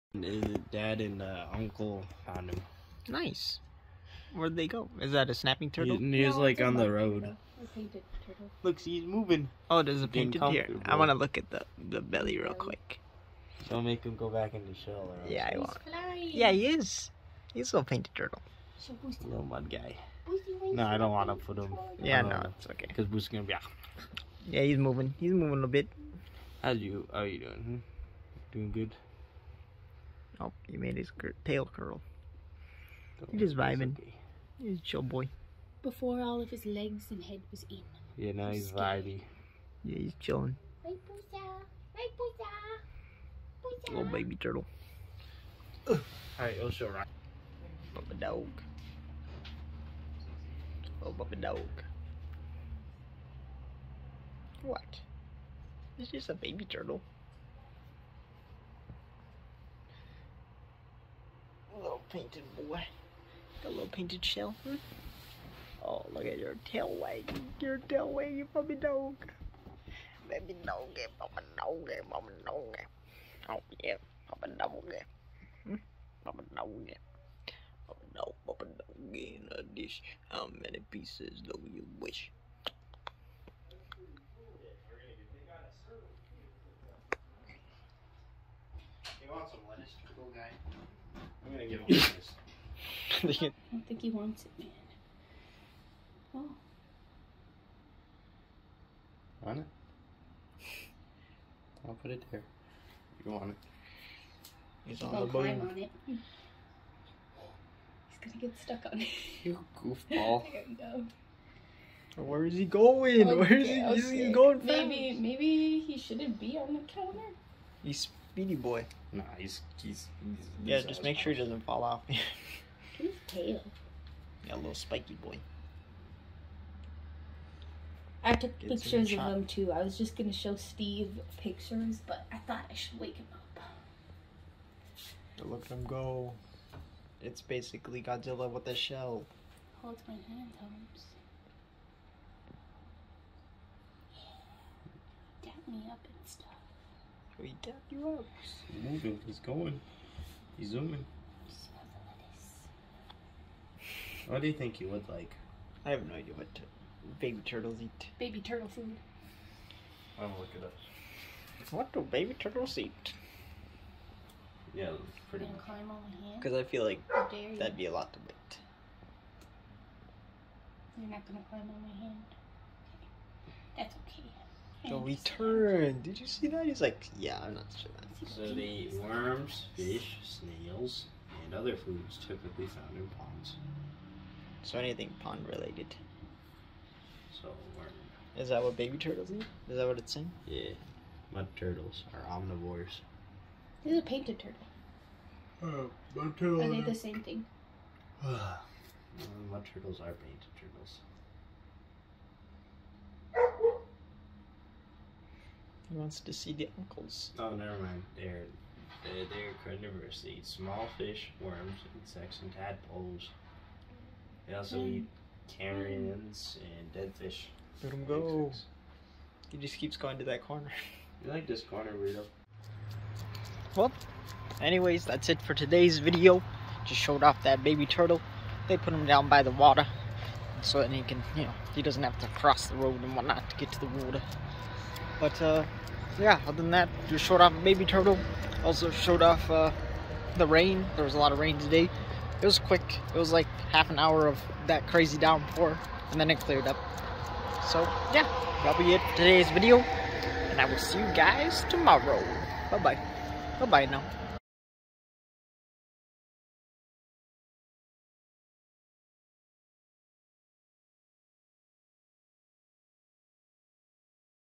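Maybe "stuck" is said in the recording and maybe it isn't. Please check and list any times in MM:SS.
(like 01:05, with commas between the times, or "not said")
01:48.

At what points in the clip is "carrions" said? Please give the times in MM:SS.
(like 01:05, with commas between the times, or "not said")
03:35.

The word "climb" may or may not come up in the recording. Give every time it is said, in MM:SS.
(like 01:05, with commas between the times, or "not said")
01:45, 02:45, 02:51.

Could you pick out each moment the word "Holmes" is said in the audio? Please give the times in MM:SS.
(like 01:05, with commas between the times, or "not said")
02:20.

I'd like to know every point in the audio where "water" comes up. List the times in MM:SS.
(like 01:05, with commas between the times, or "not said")
03:49, 03:54.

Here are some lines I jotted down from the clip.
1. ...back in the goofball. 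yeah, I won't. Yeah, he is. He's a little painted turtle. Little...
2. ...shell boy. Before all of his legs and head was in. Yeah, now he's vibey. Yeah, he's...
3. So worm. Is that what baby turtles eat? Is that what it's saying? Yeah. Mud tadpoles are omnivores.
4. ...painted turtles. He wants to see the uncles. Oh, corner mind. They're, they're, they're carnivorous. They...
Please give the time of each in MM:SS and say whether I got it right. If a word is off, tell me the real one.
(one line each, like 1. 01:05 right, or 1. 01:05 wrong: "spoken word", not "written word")
1. 00:14 wrong: "shell", not "goofball"
2. 00:34 wrong: "chill", not "shell"
3. 03:07 wrong: "turtles", not "tadpoles"
4. 03:20 wrong: "never", not "corner".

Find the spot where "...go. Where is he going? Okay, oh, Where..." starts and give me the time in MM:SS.
01:50.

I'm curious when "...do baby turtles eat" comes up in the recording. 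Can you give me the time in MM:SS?
02:41.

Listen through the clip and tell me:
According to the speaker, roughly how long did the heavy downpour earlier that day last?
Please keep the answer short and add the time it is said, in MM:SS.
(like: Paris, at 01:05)
Half an hour, at 04:03.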